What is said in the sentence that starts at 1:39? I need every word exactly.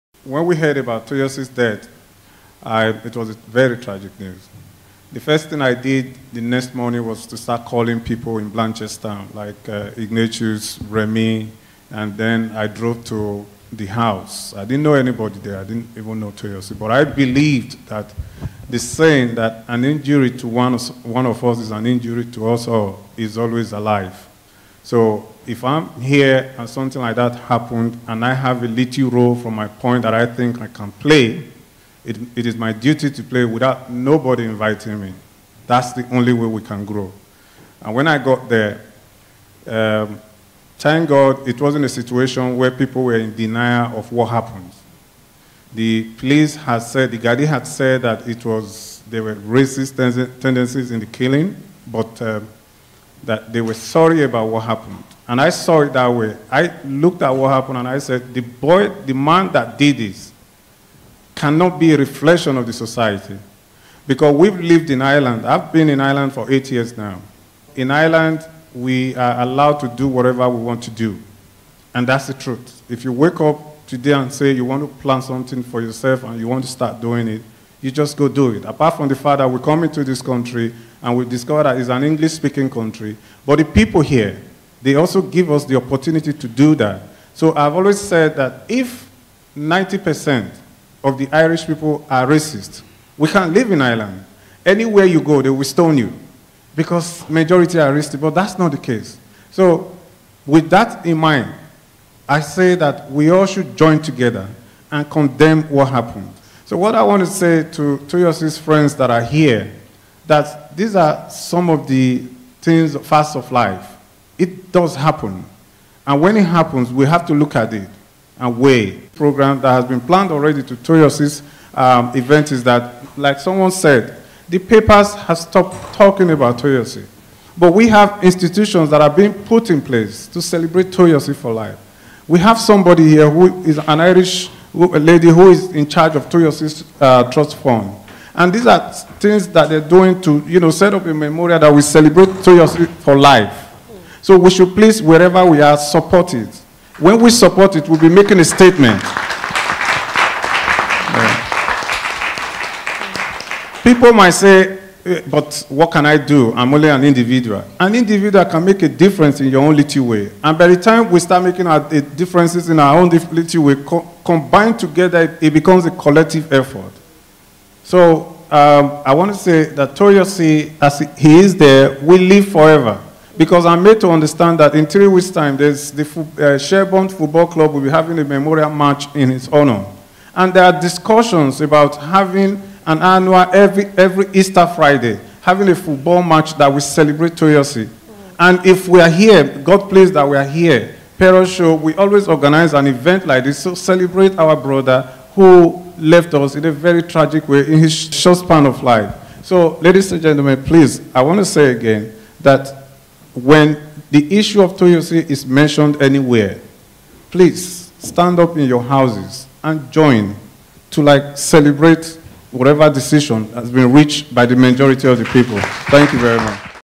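So with that in mind, I say that we all should join together and condemn what happened.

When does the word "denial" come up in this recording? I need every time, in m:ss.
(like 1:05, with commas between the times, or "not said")
0:43.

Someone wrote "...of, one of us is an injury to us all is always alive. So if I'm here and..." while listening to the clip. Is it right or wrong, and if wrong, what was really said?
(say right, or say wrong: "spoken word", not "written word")
right.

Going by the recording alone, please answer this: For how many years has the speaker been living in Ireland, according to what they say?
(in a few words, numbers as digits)
8.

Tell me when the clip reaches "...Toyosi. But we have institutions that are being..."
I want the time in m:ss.
2:06.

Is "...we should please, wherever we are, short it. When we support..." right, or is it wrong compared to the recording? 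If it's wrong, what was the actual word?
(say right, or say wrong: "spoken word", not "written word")
wrong: "support", not "short".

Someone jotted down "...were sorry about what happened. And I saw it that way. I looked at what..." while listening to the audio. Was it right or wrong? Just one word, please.
right.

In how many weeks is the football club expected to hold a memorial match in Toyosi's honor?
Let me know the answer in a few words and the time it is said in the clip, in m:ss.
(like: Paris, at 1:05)
3, at 2:54.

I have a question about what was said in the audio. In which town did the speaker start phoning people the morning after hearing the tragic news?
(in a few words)
Blanchester.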